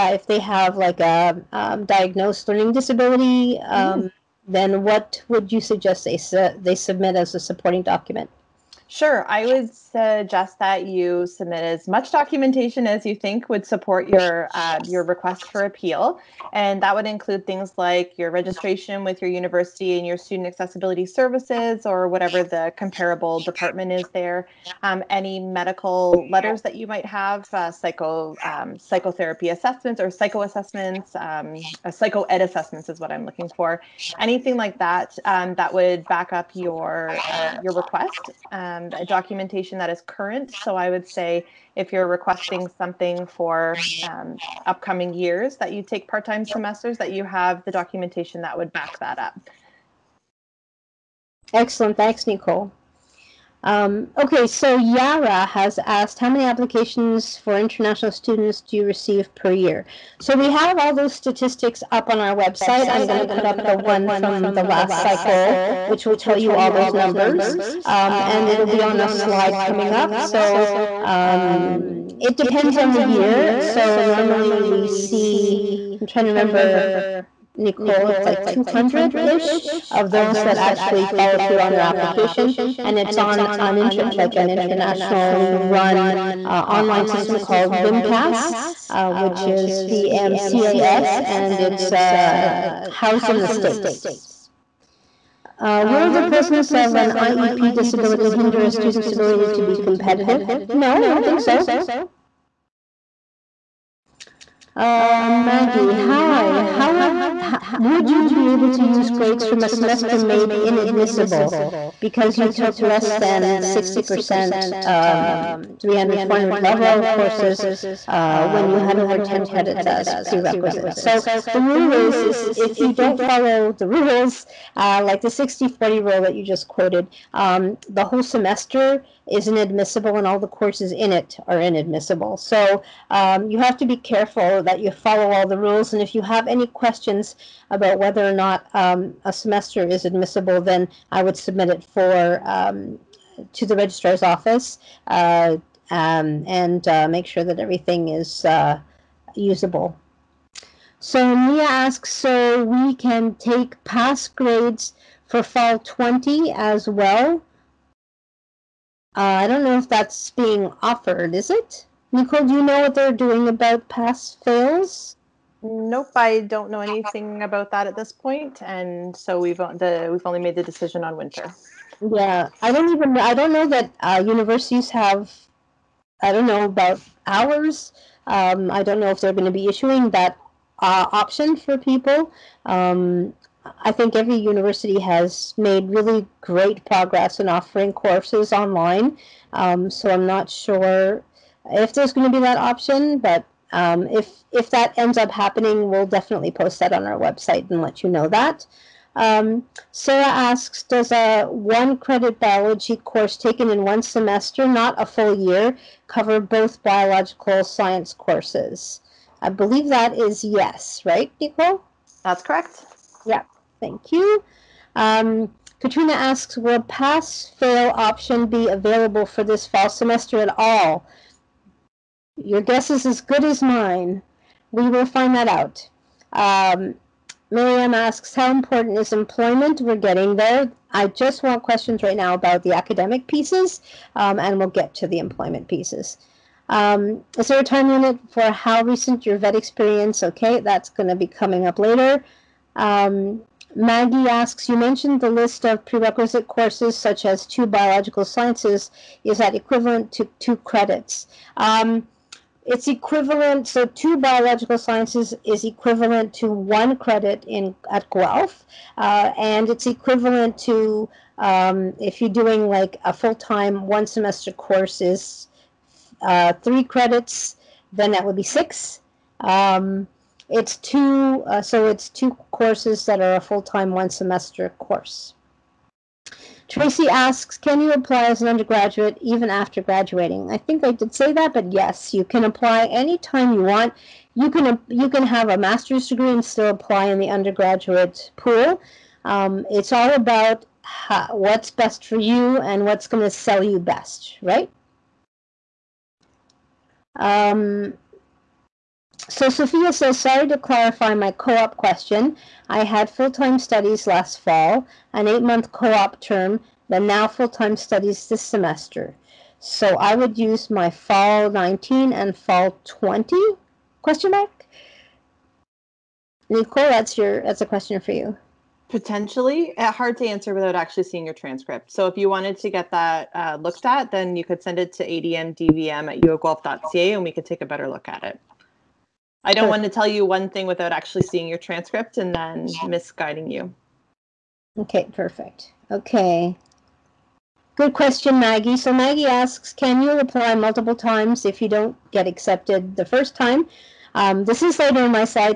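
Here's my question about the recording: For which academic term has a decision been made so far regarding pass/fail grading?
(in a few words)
Winter.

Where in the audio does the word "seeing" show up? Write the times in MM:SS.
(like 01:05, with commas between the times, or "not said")
05:21, 05:31.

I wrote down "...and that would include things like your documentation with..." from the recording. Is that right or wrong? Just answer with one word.
wrong.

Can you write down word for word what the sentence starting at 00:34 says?
Anything like that um, that would back up your uh, your request.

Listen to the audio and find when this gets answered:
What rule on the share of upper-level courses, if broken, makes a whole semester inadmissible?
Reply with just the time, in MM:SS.
02:05.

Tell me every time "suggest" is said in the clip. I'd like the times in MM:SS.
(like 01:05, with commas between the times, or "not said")
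00:05, 00:09.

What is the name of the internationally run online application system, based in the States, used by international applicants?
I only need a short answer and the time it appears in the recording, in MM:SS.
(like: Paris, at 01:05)
VMCAS, at 01:29.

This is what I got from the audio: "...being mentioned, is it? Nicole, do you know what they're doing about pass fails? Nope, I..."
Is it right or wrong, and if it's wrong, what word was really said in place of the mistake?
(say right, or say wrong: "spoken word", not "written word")
wrong: "offered", not "mentioned".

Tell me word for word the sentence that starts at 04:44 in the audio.
You can you can have a master's degree and still apply in the undergraduate pool.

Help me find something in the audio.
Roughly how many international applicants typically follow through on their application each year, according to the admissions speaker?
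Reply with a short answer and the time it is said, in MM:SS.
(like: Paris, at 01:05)
200, at 01:18.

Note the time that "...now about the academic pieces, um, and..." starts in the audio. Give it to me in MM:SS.
03:52.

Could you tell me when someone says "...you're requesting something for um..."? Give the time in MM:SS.
00:41.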